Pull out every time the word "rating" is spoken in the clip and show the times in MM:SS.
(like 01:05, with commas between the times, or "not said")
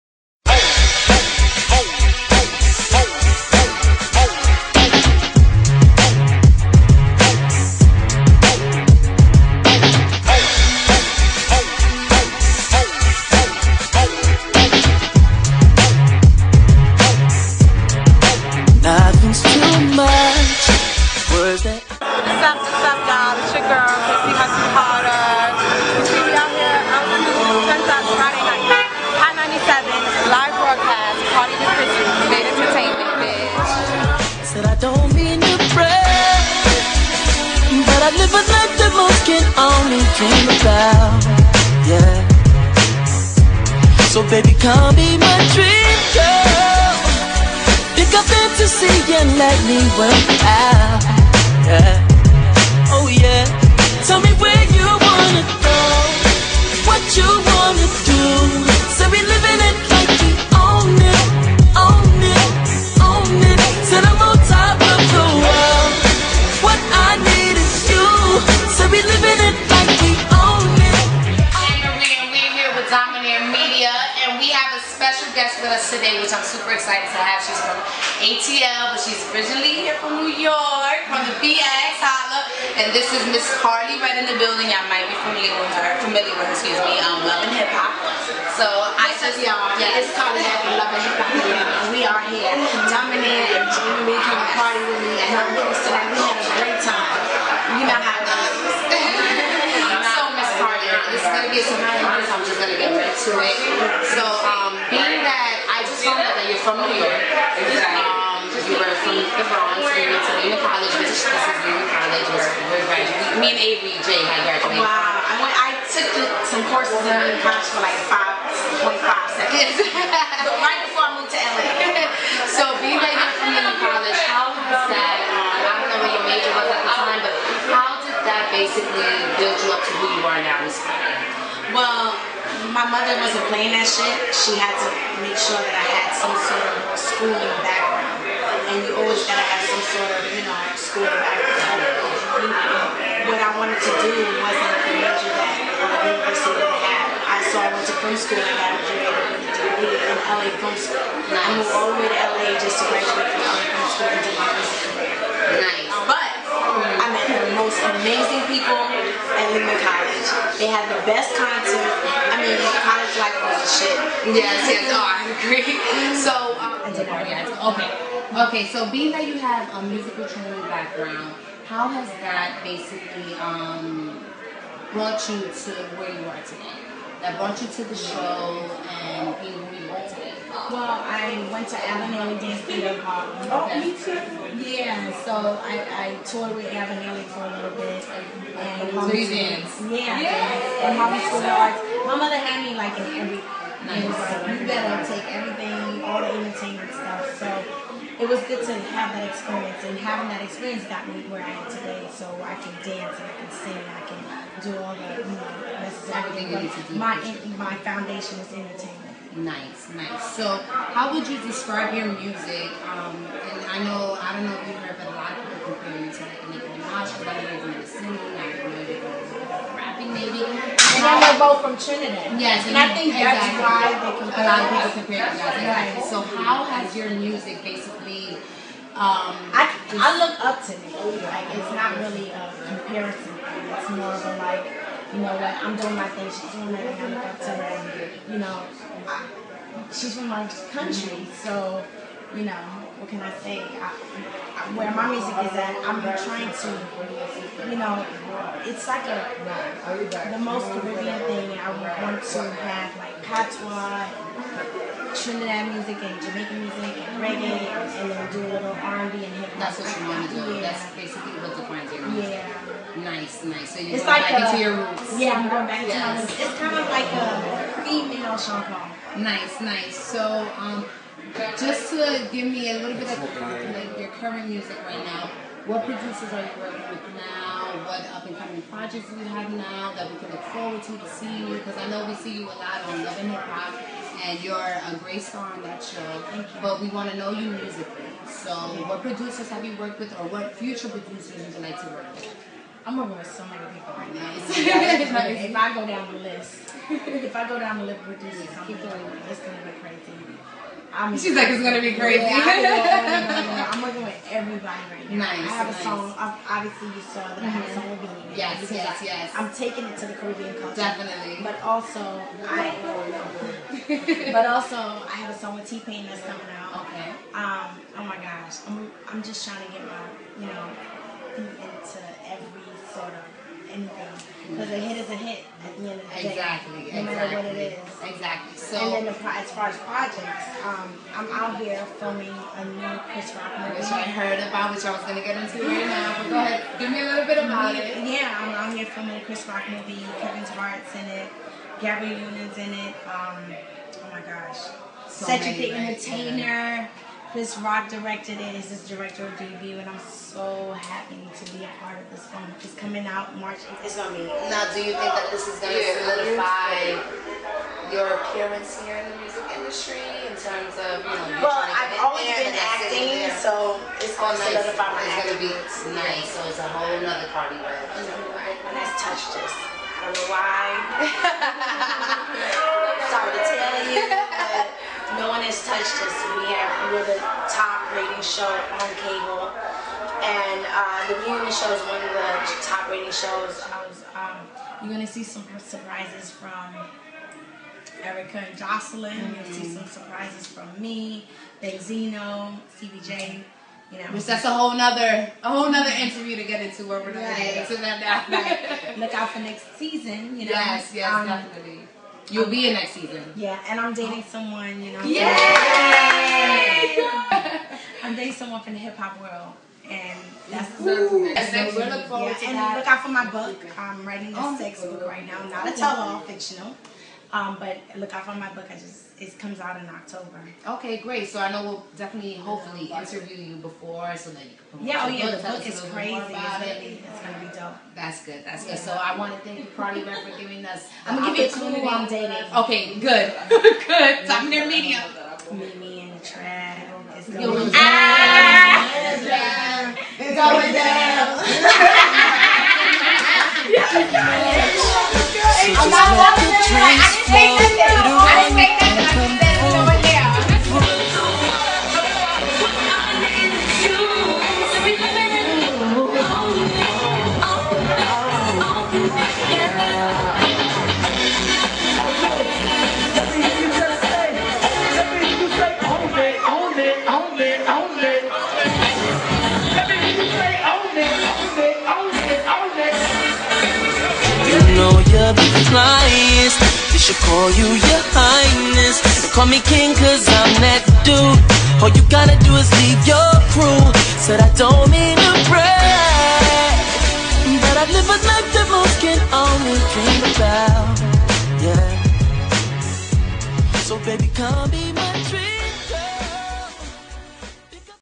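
06:17, 06:22.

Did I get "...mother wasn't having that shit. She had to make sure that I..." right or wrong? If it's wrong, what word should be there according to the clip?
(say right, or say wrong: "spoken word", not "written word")
wrong: "playing", not "having".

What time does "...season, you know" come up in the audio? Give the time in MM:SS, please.
06:39.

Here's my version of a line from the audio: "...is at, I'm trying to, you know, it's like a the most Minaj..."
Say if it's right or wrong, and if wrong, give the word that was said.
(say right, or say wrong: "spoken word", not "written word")
wrong: "Caribbean", not "Minaj".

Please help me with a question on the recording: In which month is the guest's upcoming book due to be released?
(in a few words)
October.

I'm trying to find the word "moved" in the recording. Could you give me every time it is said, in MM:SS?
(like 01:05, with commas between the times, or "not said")
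02:01, 02:31.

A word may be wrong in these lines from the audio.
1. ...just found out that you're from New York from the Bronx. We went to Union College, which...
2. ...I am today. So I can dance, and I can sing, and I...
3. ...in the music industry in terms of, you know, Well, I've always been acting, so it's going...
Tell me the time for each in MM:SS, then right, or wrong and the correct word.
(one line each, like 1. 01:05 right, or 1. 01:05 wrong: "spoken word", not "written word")
1. 01:45 right
2. 03:21 right
3. 05:58 right.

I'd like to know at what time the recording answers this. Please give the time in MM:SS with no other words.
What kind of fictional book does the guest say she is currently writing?
06:54.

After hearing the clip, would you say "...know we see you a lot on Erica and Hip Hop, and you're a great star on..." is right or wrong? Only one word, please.
wrong.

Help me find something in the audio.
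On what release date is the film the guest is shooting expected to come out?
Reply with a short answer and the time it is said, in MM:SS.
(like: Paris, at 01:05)
March 8th, at 05:53.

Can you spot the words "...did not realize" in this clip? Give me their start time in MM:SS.
02:46.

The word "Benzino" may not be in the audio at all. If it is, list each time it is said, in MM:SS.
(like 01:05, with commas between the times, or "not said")
06:31.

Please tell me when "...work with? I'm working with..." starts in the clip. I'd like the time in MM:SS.
04:51.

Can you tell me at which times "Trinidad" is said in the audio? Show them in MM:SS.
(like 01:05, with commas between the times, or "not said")
03:41, 04:15.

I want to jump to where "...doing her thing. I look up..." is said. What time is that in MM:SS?
03:56.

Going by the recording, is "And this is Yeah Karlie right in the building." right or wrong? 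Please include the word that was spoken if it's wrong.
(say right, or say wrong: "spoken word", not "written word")
wrong: "Miss", not "Yeah".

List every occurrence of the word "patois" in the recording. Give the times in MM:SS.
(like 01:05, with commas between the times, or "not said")
04:13.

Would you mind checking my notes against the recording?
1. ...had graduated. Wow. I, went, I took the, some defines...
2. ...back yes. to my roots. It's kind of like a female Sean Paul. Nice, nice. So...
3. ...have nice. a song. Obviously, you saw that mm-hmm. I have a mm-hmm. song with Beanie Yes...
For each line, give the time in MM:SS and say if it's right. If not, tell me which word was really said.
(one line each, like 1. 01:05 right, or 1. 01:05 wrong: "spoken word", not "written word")
1. 01:54 wrong: "courses", not "defines"
2. 04:25 right
3. 05:05 right.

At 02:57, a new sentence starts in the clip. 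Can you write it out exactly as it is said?
That brought you to the show and being who you are today?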